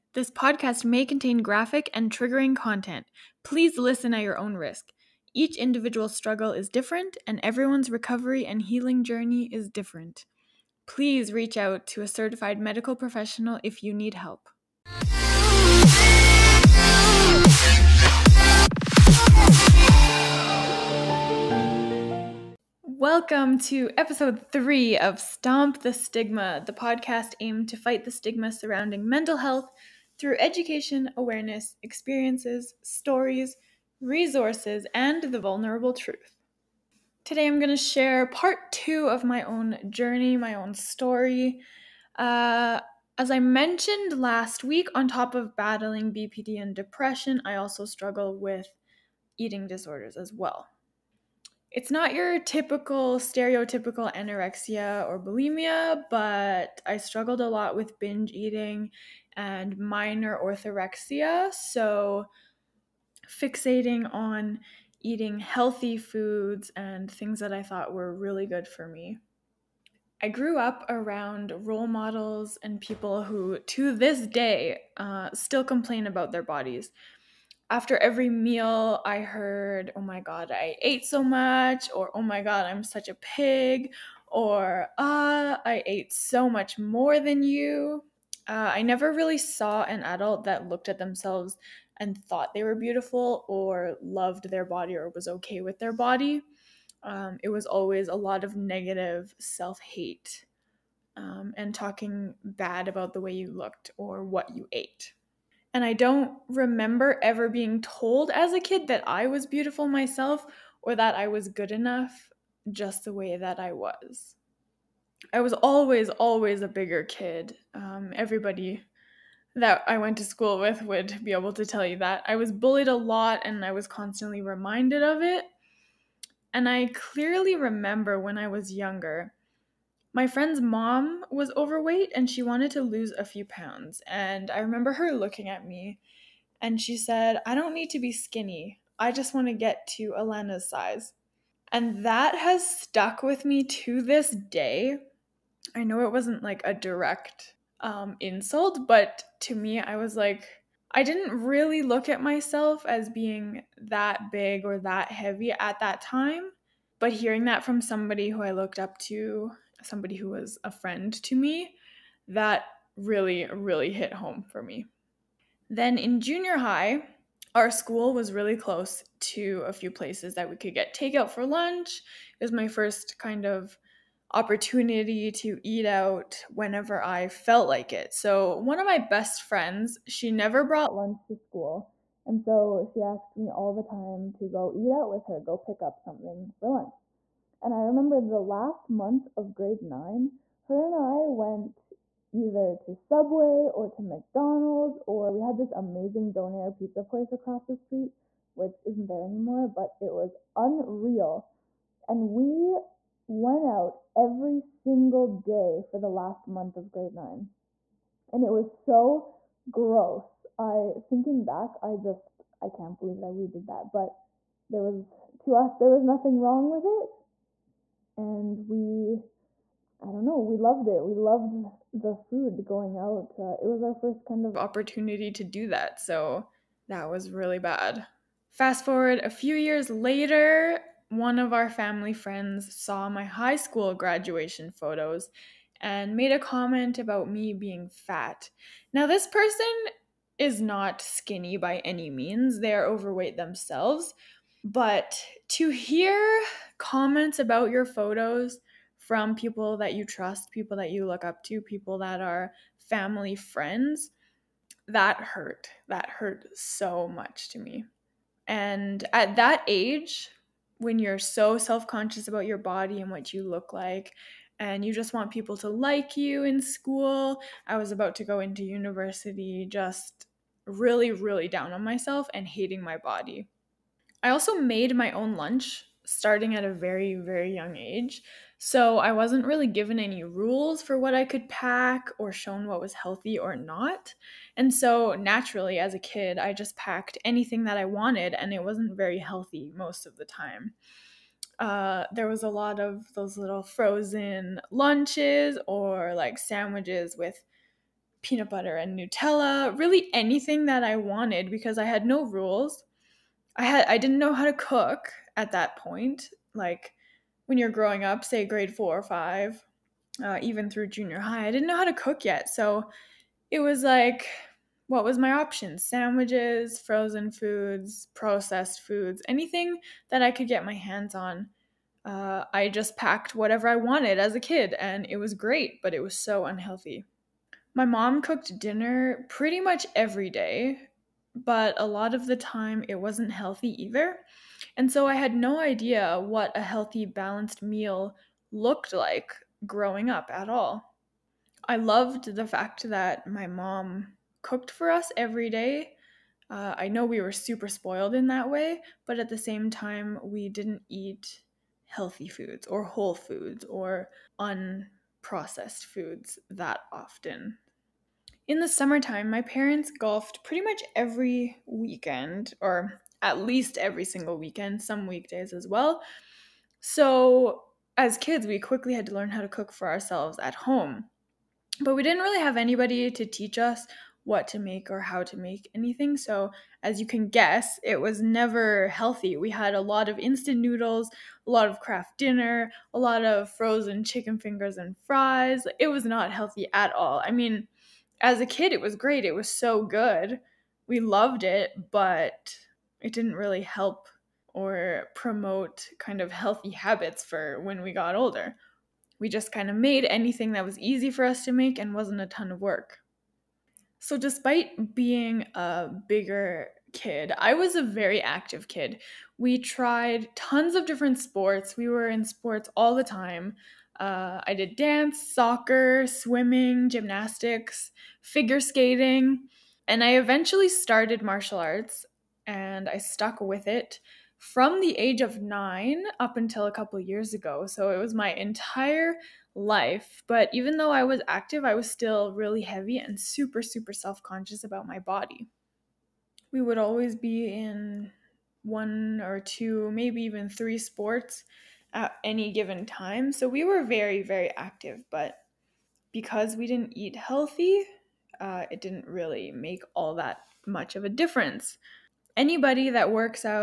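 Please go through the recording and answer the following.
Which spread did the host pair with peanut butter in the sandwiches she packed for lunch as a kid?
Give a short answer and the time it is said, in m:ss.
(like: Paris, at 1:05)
Nutella, at 4:58.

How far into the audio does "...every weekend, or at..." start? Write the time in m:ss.
6:00.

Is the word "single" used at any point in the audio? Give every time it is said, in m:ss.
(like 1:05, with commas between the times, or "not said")
3:24, 6:04.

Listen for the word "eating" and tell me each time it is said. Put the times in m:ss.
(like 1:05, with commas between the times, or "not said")
0:49, 0:58, 1:05.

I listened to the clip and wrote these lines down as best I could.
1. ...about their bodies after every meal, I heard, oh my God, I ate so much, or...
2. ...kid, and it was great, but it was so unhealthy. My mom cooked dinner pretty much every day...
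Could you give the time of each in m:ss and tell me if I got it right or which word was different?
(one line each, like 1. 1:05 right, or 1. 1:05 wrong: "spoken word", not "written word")
1. 1:16 right
2. 5:24 right.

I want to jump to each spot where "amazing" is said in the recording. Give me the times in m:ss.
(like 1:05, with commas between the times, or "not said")
3:15.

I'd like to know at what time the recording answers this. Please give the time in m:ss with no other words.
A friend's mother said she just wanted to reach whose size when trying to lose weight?
2:20.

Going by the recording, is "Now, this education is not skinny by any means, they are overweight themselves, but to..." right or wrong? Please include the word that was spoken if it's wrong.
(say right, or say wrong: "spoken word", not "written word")
wrong: "person", not "education".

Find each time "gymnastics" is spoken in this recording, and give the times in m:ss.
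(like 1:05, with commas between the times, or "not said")
6:56.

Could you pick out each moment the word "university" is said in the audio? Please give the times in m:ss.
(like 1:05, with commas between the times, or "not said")
4:28.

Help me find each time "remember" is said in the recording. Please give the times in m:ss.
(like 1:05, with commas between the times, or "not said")
1:46, 2:07, 2:14, 3:07.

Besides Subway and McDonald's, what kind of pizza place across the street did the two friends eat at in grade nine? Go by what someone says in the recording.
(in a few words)
donair pizza.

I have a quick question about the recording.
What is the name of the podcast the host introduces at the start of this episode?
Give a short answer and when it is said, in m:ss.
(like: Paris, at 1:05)
Stomp the Stigma, at 0:25.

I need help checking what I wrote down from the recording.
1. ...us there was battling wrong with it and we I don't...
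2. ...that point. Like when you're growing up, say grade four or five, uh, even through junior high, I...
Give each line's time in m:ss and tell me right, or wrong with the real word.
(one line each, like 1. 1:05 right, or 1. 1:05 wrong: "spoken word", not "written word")
1. 3:35 wrong: "nothing", not "battling"
2. 5:05 right.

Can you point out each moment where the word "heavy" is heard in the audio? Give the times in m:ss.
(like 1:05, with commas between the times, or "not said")
2:35, 7:12.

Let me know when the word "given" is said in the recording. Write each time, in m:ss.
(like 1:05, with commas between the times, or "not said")
4:39, 7:22.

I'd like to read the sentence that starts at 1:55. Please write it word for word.
I was always, always a bigger kid.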